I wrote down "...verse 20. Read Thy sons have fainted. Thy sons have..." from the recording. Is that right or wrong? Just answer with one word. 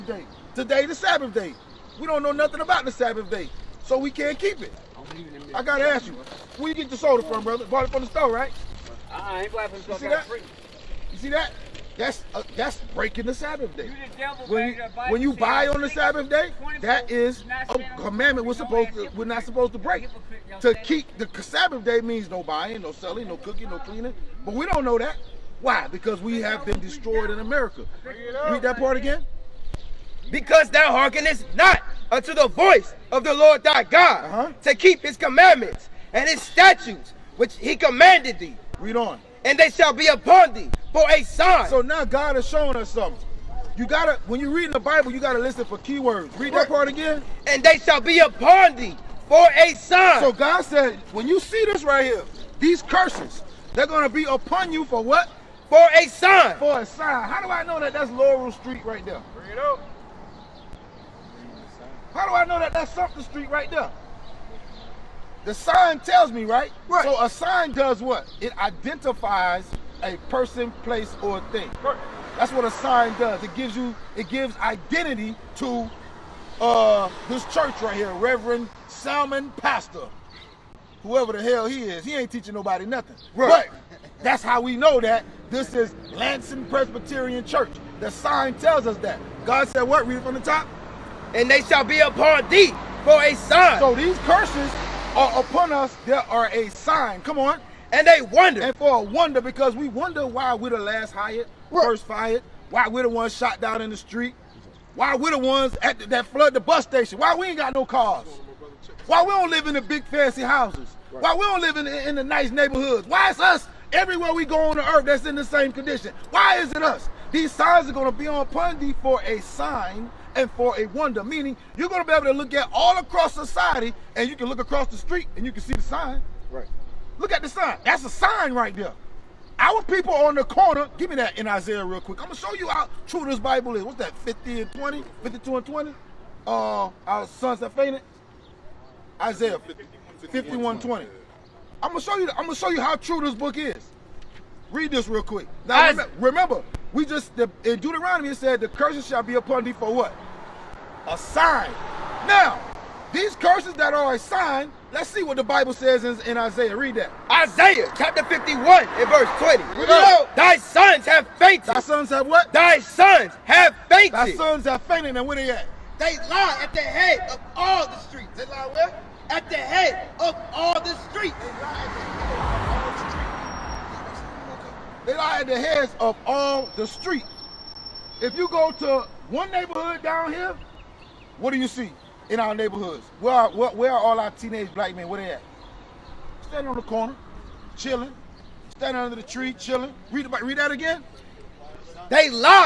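right.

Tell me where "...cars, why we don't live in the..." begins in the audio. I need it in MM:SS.
01:47.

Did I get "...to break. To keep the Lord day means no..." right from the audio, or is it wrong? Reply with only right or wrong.
wrong.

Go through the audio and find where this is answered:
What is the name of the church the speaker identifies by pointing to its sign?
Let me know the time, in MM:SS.
01:26.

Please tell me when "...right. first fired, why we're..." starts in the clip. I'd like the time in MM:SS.
01:41.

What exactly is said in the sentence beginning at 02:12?
I'm going to show you how true this Bible is.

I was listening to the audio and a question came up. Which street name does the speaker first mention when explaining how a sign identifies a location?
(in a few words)
Laurel Street.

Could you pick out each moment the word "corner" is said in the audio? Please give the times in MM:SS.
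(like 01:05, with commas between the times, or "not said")
02:10, 03:06.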